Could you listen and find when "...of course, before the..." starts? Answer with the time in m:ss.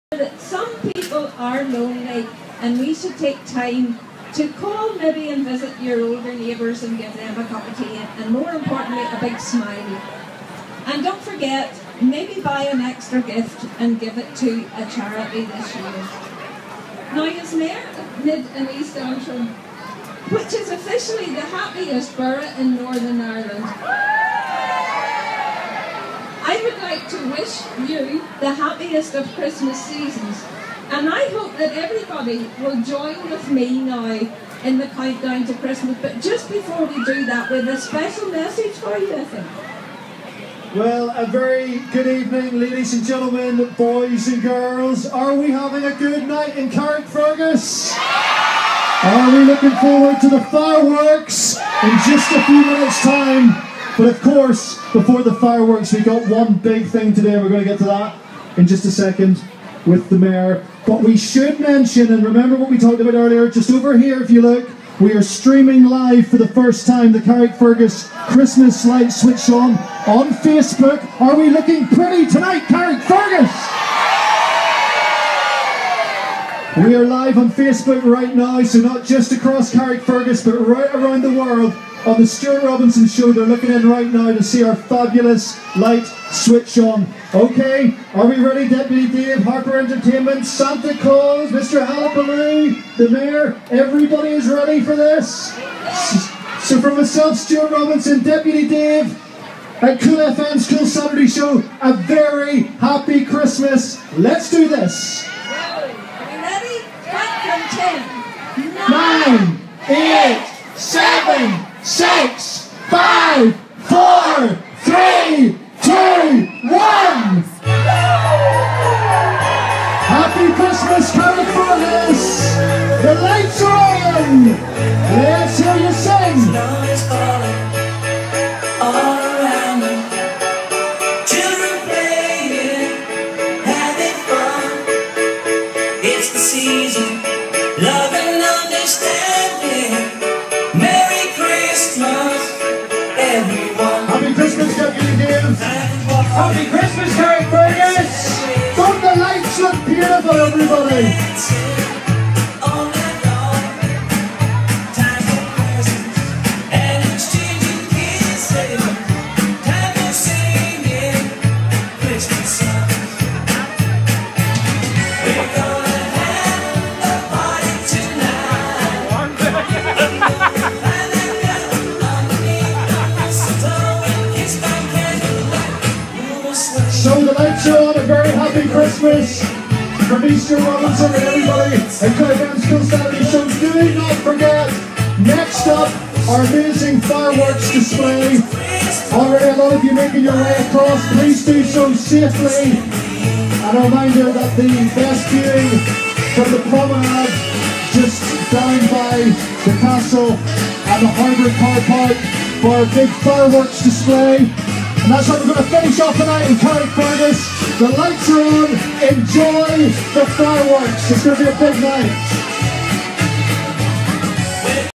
0:54.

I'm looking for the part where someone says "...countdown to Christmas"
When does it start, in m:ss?
0:34.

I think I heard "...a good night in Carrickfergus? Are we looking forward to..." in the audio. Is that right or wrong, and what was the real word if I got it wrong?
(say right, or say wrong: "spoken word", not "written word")
right.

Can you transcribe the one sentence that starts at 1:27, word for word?
Okay, are we ready, Deputy Dave, Harper Entertainment, Santa Claus, Mr.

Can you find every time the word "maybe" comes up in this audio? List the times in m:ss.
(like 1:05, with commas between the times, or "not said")
0:04, 0:12.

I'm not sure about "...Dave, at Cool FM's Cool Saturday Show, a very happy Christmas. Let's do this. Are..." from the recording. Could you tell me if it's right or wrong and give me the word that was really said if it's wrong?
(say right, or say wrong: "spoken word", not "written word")
right.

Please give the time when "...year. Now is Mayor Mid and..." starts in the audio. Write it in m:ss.
0:15.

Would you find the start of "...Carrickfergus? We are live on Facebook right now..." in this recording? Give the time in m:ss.
1:12.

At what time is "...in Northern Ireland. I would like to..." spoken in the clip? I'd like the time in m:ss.
0:22.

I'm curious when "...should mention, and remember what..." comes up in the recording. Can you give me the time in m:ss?
1:01.